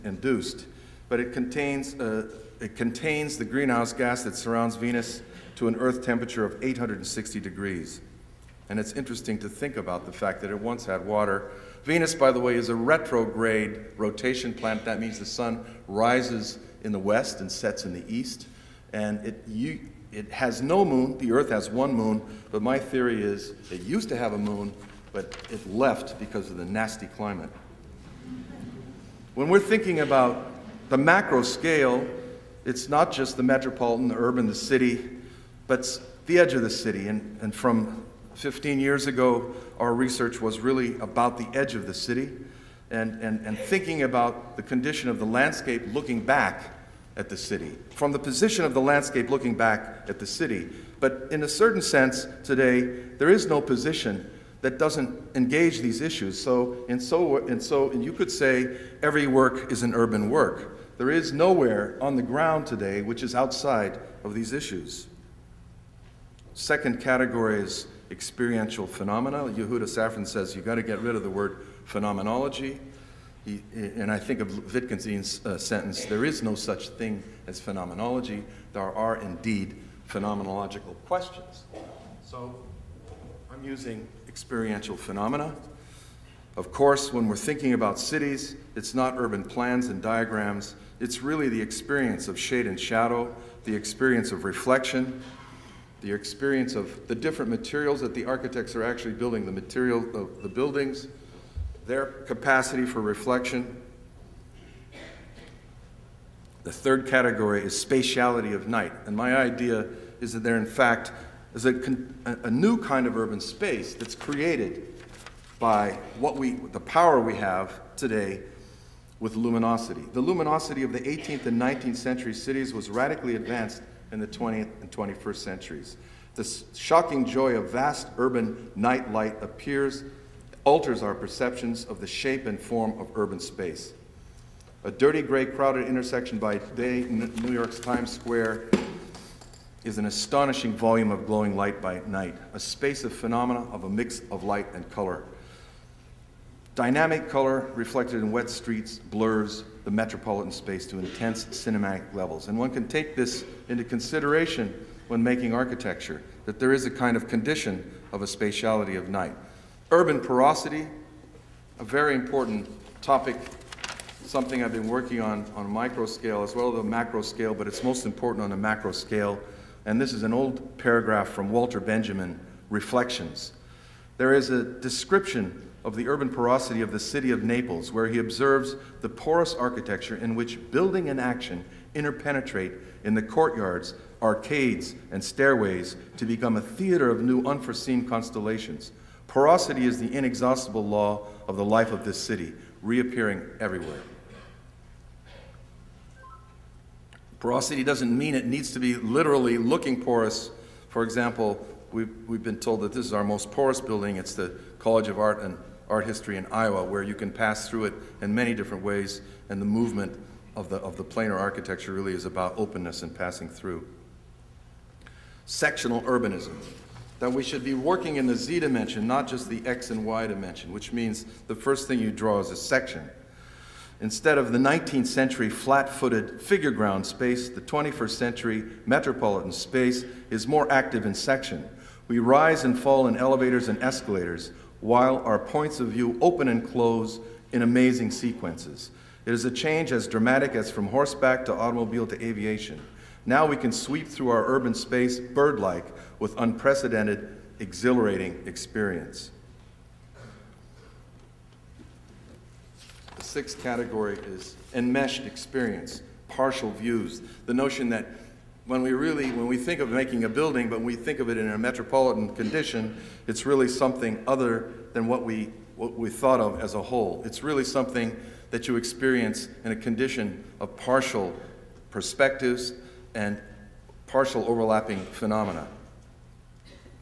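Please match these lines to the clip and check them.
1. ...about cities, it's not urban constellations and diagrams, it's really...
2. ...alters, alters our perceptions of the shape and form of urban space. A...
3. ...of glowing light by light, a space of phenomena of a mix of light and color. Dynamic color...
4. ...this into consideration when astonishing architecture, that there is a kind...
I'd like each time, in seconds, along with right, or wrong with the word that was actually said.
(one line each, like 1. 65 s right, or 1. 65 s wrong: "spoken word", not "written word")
1. 87 s wrong: "plans", not "constellations"
2. 129 s wrong: "appears", not "alters"
3. 141 s wrong: "night", not "light"
4. 153 s wrong: "making", not "astonishing".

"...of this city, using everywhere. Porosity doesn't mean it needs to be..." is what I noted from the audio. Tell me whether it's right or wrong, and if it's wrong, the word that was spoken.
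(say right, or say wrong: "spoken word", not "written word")
wrong: "reappearing", not "using".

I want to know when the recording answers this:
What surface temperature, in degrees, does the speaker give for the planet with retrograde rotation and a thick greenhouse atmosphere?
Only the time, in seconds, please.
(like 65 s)
6 s.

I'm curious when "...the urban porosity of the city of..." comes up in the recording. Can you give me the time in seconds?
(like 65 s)
175 s.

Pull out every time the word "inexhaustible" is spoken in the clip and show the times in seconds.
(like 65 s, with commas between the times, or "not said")
190 s.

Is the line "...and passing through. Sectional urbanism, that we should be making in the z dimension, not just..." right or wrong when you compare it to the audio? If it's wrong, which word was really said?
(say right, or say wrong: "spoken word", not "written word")
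wrong: "working", not "making".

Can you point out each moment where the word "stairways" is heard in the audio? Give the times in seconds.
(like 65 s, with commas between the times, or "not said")
185 s.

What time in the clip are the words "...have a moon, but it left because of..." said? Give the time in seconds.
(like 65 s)
24 s.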